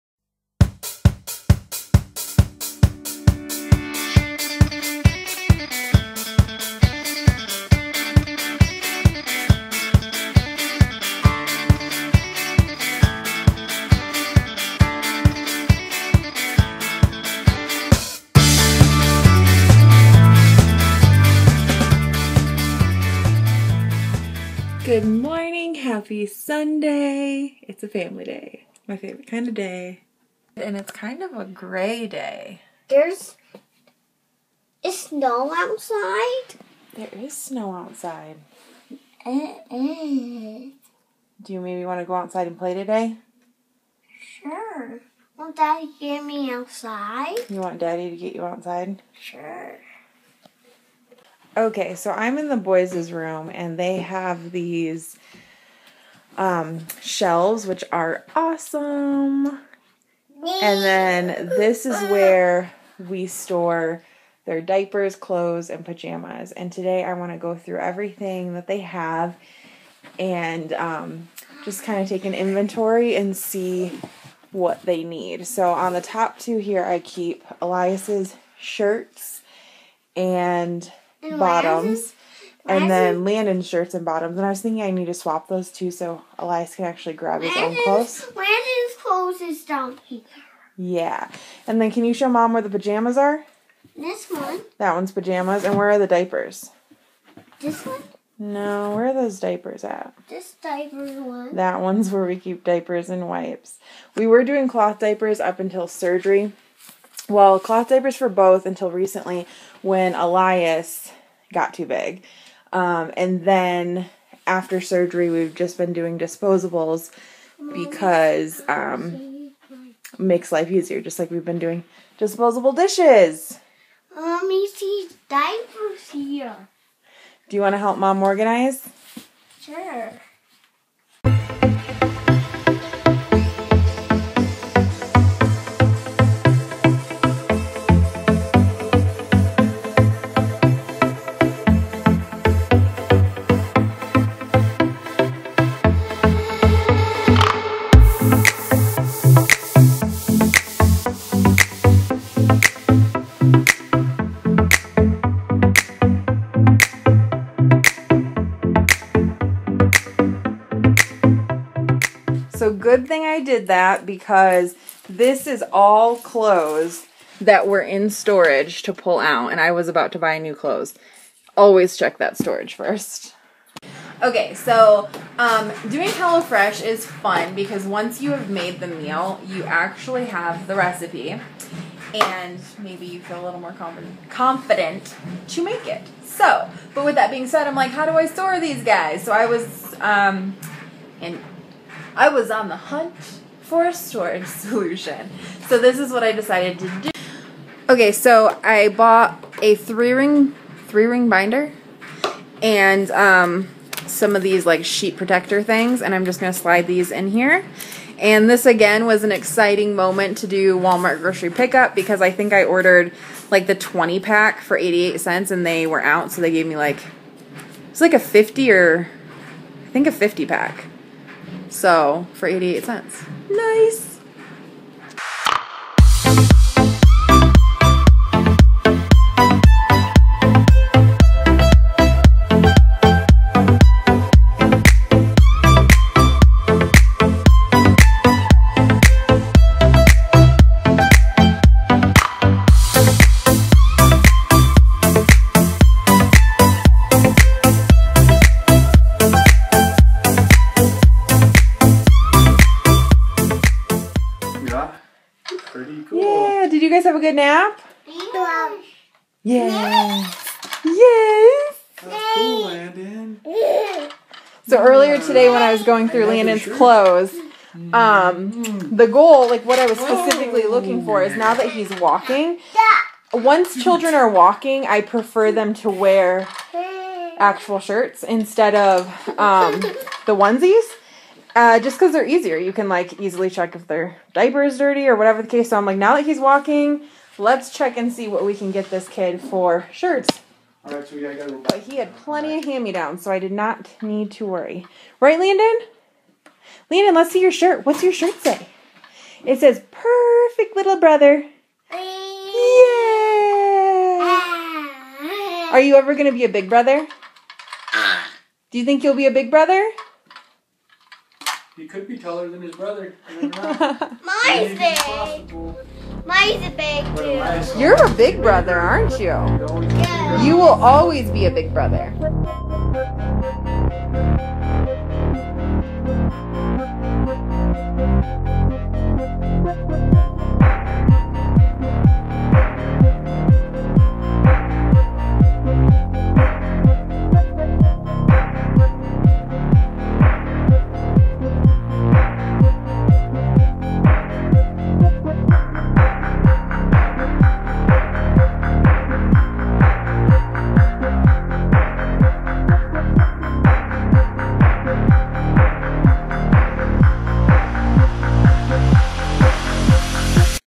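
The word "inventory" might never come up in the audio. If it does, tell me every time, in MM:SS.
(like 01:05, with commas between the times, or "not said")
01:12.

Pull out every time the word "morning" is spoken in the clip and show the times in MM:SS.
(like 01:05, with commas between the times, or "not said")
00:25.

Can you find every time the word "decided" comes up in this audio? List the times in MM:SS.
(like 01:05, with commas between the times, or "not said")
03:16.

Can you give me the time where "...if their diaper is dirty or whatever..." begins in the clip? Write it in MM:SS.
04:43.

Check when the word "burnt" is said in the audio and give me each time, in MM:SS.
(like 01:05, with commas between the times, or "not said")
not said.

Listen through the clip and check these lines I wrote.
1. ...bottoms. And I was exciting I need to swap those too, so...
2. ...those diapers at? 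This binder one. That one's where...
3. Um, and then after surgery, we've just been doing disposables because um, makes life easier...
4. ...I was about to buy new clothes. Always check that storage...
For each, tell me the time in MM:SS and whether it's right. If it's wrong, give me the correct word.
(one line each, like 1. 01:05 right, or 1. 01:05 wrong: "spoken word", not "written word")
1. 01:24 wrong: "thinking", not "exciting"
2. 01:39 wrong: "diaper", not "binder"
3. 01:52 right
4. 02:49 right.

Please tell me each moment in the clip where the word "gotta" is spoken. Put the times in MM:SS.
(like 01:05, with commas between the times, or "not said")
04:51.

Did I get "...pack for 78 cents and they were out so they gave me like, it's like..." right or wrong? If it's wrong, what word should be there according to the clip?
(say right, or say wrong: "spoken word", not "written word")
wrong: "88", not "78".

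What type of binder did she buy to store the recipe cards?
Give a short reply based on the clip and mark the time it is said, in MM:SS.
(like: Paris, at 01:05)
Three ring binder, at 03:20.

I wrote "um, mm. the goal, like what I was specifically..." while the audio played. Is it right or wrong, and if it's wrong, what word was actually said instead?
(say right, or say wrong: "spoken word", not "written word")
right.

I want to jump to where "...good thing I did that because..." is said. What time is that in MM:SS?
02:42.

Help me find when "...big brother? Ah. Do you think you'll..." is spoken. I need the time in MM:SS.
05:06.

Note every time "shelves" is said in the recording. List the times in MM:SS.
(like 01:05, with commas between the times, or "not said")
00:57.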